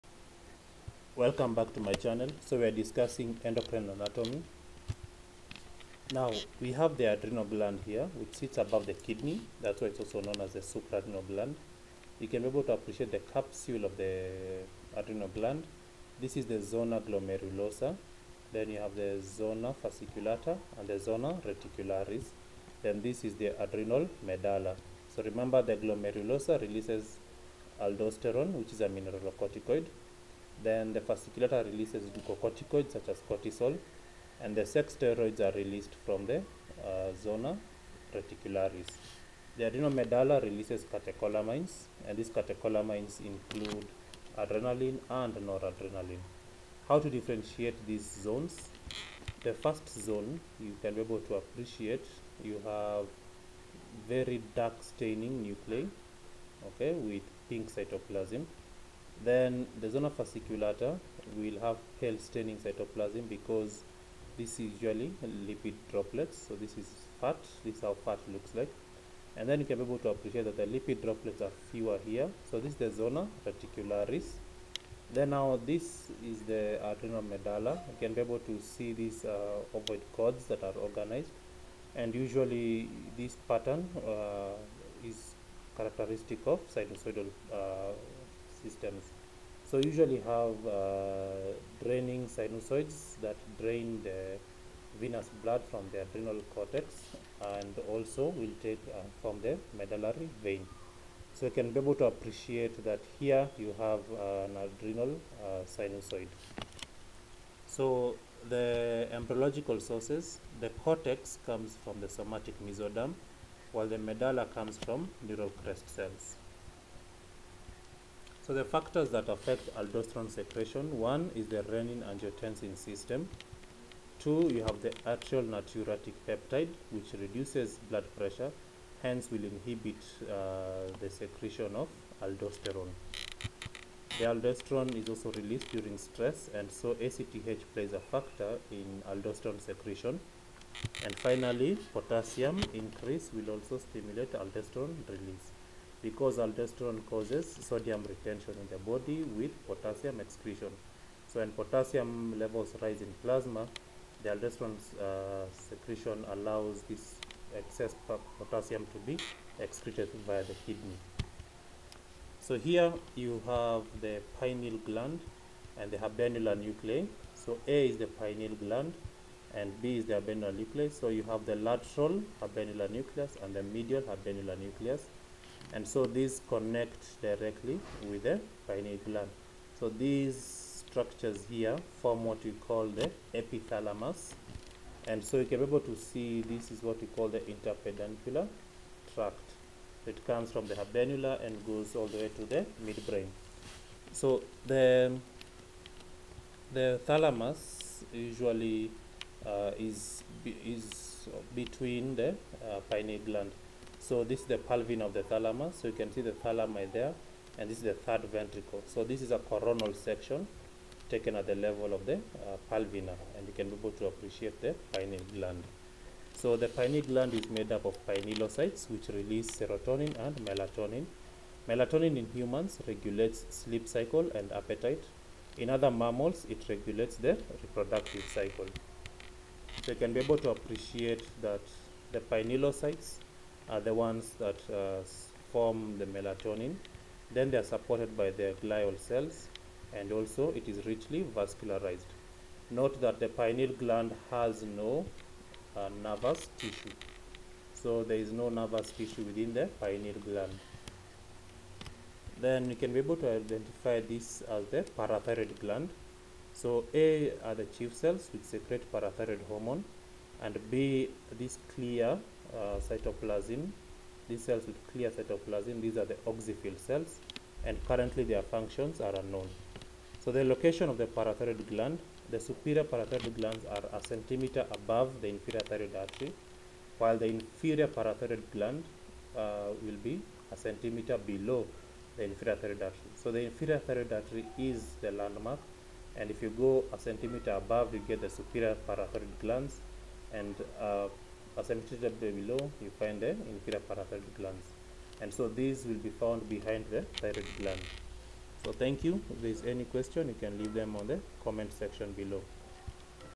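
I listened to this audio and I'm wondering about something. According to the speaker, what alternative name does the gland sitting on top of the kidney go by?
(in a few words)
supraadrenal gland.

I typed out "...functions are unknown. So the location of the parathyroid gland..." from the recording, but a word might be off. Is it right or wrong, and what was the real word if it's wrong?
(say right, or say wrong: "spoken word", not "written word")
right.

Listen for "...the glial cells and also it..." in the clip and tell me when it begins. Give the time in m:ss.
3:58.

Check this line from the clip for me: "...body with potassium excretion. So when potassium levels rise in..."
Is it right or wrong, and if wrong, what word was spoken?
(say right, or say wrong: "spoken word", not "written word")
right.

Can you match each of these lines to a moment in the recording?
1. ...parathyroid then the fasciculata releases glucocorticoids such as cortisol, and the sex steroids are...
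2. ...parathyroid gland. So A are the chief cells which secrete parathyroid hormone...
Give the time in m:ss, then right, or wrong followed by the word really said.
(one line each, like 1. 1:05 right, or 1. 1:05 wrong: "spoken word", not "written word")
1. 0:28 wrong: "mineralocorticoid", not "parathyroid"
2. 4:14 right.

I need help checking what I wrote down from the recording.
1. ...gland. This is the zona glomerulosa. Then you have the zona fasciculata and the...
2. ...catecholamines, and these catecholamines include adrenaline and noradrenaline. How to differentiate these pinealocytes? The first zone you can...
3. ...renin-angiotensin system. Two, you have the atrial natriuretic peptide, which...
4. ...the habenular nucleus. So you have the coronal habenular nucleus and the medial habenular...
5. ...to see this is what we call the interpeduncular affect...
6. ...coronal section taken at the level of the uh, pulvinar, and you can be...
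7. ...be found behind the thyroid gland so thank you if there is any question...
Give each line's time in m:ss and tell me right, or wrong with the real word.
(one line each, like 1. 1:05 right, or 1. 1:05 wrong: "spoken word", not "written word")
1. 0:15 right
2. 0:40 wrong: "zones", not "pinealocytes"
3. 2:01 right
4. 2:50 wrong: "lateral", not "coronal"
5. 3:05 wrong: "tract", not "affect"
6. 3:29 right
7. 4:56 right.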